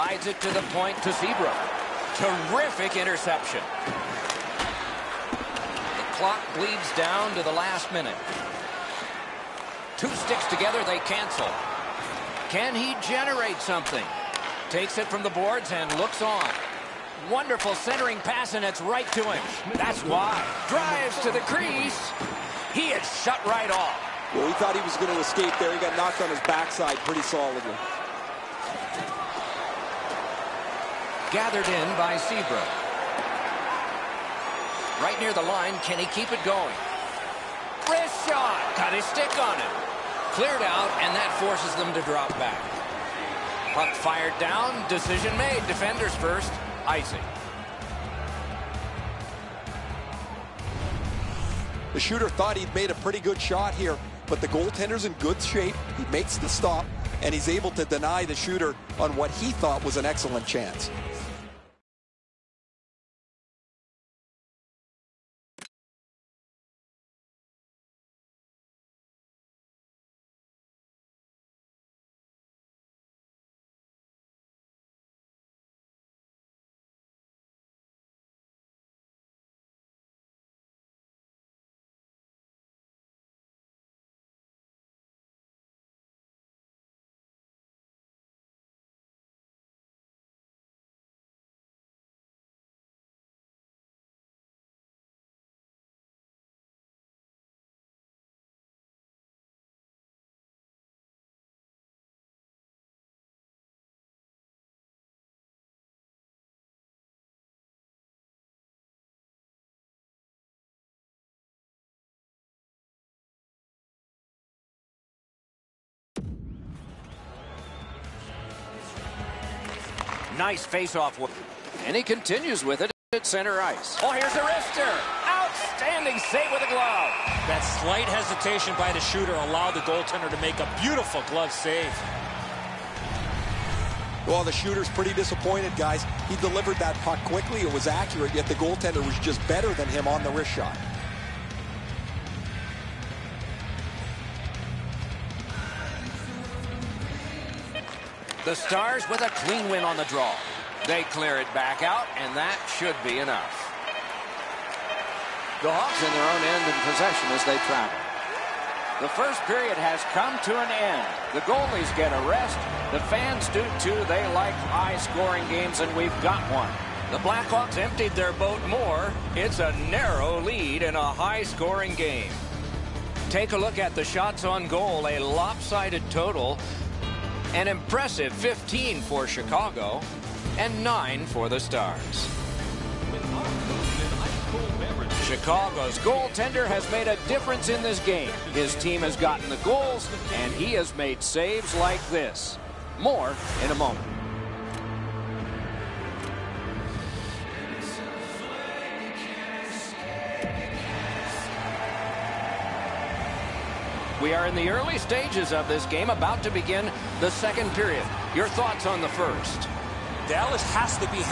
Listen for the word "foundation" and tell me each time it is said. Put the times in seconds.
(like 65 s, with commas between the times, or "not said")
not said.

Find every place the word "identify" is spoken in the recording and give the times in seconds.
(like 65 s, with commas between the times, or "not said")
not said.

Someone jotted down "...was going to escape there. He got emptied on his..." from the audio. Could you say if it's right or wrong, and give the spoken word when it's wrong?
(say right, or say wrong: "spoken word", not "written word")
wrong: "knocked", not "emptied".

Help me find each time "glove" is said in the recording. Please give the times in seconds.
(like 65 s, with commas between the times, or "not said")
126 s, 131 s.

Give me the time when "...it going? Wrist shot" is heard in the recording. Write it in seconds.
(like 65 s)
36 s.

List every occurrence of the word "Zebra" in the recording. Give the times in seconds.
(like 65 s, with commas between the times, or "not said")
1 s, 32 s.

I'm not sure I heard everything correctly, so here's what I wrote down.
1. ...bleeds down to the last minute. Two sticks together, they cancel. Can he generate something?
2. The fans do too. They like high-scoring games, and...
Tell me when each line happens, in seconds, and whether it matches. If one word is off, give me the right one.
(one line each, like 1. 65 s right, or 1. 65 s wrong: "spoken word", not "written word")
1. 6 s right
2. 162 s right.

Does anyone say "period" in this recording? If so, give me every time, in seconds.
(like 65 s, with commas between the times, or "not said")
159 s, 207 s.